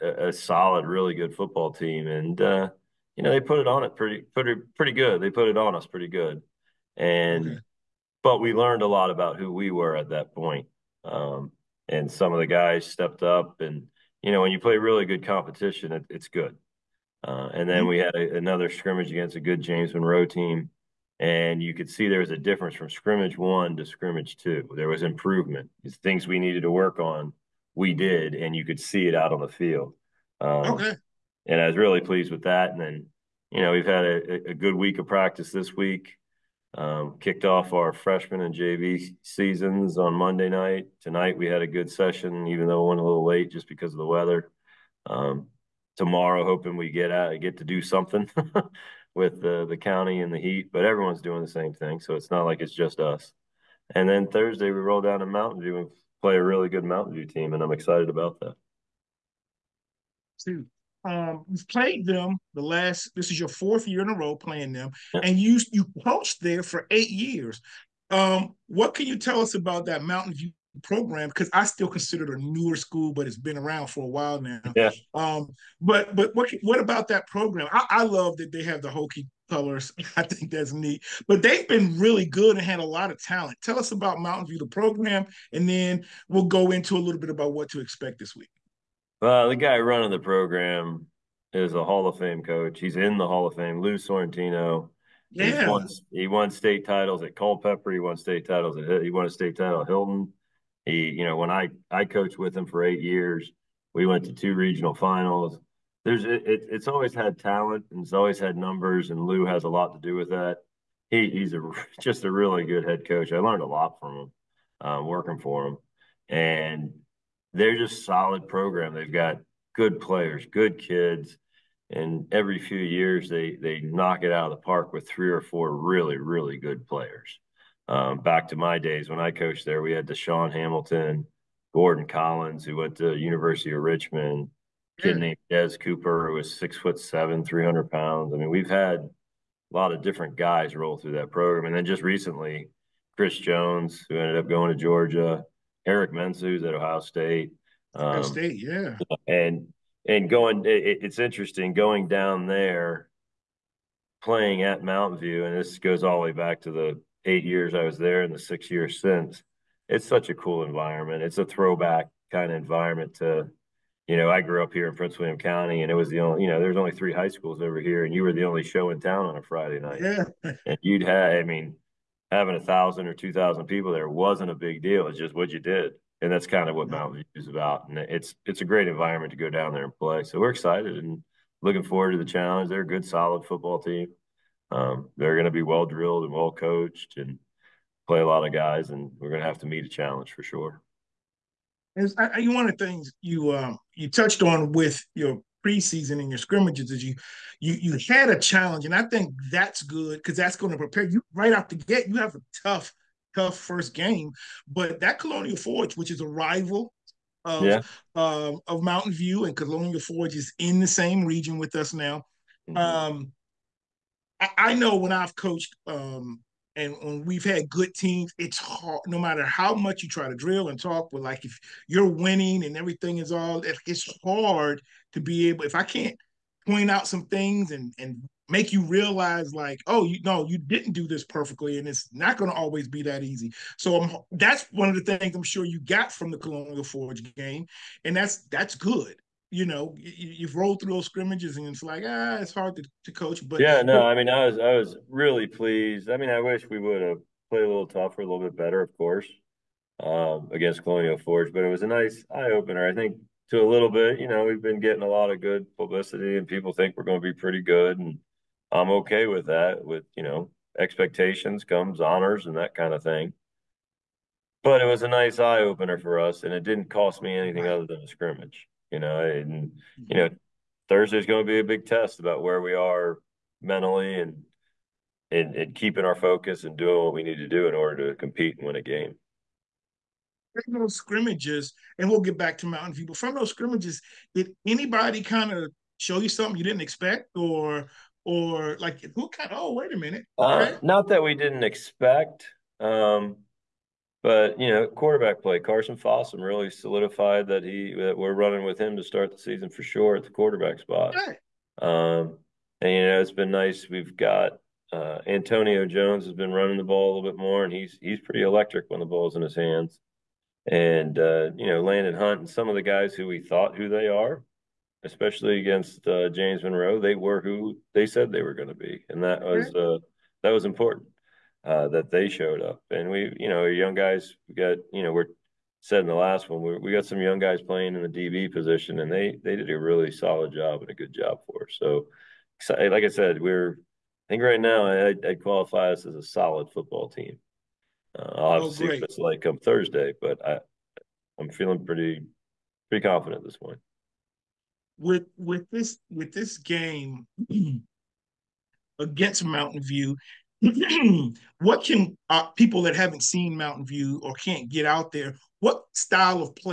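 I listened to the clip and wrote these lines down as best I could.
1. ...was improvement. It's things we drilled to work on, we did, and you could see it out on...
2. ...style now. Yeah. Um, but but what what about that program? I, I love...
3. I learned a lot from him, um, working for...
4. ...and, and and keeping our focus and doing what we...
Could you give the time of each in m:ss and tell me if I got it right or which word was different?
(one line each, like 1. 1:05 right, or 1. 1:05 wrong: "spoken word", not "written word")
1. 0:24 wrong: "needed", not "drilled"
2. 1:14 wrong: "while", not "style"
3. 1:53 right
4. 4:34 right.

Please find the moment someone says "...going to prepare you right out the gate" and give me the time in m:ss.
3:20.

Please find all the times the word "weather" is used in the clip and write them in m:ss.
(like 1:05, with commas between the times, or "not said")
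0:44.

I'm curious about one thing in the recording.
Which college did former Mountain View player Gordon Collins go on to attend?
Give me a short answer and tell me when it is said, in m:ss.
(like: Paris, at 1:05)
University of Richmond, at 2:13.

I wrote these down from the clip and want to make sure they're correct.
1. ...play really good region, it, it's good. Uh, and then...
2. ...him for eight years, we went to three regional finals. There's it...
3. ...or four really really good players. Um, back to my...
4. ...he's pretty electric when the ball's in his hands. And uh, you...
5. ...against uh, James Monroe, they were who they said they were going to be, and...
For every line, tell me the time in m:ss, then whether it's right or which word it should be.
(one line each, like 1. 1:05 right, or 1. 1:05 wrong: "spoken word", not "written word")
1. 0:14 wrong: "competition", not "region"
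2. 1:42 wrong: "two", not "three"
3. 2:05 right
4. 5:08 right
5. 5:15 right.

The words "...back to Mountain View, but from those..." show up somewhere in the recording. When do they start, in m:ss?
4:42.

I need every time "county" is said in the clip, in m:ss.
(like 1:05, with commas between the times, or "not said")
0:49, 2:45.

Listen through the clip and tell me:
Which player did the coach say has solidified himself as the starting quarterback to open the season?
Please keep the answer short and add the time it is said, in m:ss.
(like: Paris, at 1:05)
Carson Fossum, at 4:55.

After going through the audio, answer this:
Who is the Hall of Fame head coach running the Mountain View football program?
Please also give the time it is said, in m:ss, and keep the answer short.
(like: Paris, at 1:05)
Lou Sorrentino, at 1:33.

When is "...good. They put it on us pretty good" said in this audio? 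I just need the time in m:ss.
0:04.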